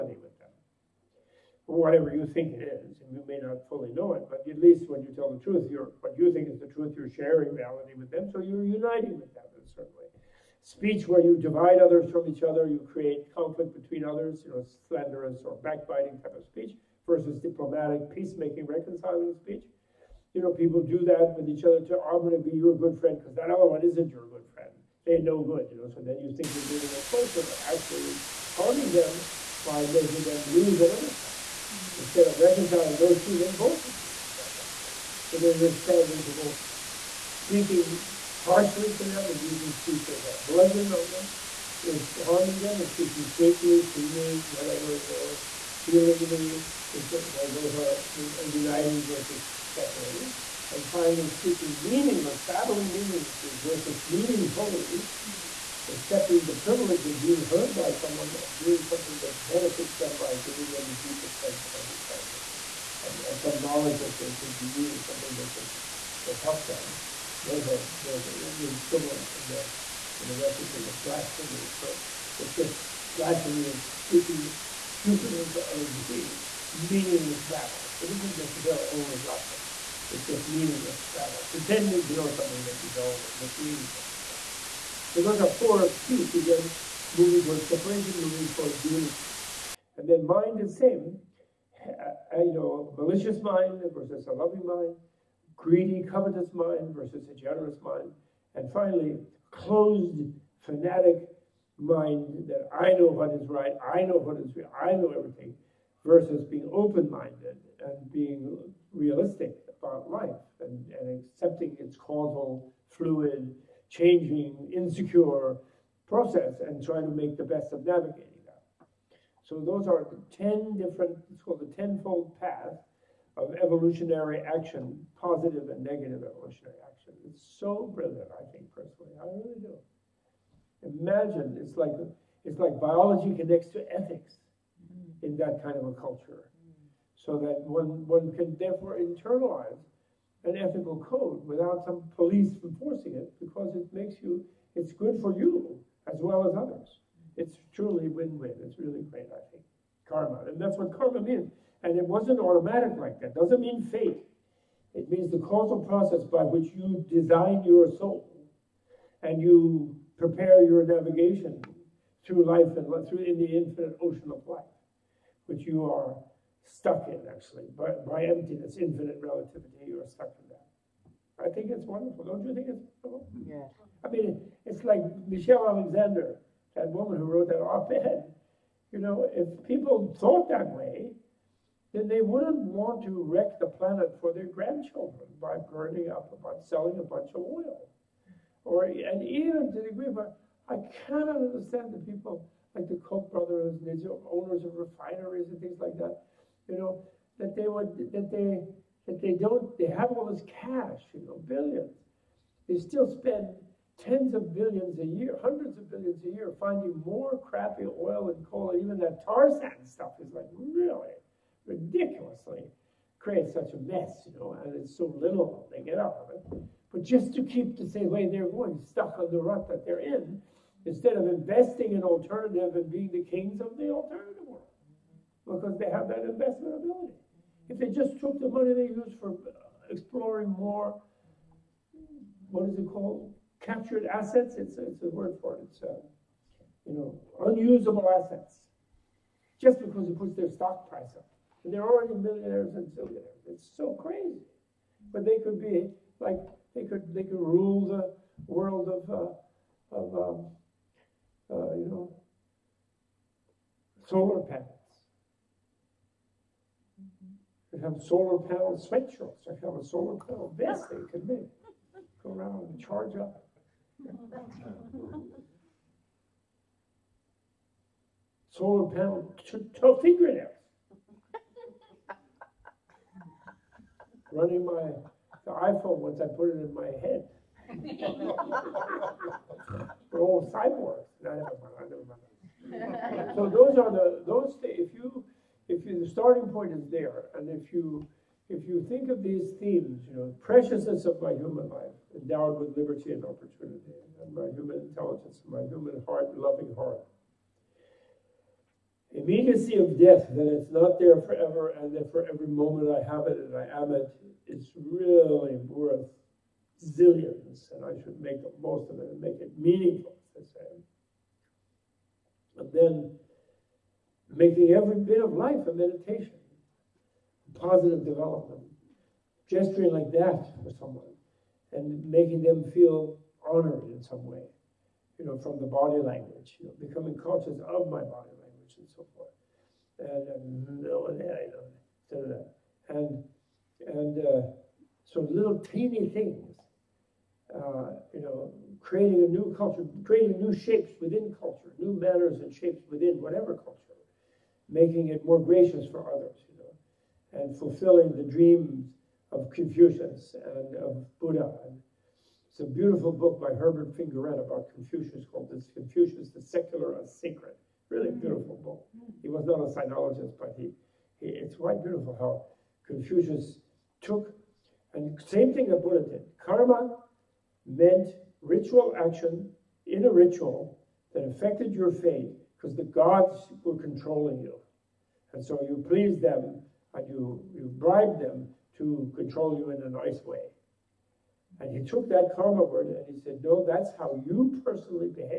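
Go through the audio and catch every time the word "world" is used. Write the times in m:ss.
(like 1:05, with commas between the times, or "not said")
3:44, 4:08.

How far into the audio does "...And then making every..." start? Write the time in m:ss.
5:12.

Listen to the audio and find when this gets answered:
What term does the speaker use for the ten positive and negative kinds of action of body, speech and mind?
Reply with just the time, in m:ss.
2:01.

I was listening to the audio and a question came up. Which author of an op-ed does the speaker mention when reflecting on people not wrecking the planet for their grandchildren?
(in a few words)
Michelle Alexander.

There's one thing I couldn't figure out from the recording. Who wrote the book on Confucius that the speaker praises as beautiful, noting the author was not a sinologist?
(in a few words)
Herbert Fingarette.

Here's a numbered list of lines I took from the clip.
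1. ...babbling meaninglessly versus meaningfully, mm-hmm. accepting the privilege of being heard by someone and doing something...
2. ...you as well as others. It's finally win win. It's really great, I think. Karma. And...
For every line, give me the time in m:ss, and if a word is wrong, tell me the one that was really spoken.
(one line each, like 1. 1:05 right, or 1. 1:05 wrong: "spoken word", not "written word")
1. 0:52 right
2. 2:25 wrong: "truly", not "finally".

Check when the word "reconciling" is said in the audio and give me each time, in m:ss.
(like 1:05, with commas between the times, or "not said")
0:18, 0:32.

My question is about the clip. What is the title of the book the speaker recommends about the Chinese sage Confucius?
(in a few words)
Confucius, the Secular and Sacred.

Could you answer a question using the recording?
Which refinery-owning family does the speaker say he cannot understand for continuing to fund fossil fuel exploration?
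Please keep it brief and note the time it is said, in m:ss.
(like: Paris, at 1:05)
the Koch brothers, at 3:12.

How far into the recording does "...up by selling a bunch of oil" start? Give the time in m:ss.
3:06.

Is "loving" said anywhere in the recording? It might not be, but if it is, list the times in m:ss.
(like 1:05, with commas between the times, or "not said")
1:34, 4:56.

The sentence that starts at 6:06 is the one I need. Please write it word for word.
Karma meant ritual action in a ritual that affected your fate because the gods were controlling you.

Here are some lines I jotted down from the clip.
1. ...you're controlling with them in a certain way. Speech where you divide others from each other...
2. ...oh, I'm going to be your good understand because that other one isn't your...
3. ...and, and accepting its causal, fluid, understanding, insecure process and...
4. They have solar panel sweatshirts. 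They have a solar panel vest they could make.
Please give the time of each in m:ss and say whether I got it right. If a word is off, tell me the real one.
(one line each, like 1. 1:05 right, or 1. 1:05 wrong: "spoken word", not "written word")
1. 0:08 wrong: "uniting", not "controlling"
2. 0:21 wrong: "friend", not "understand"
3. 1:50 wrong: "changing", not "understanding"
4. 4:17 right.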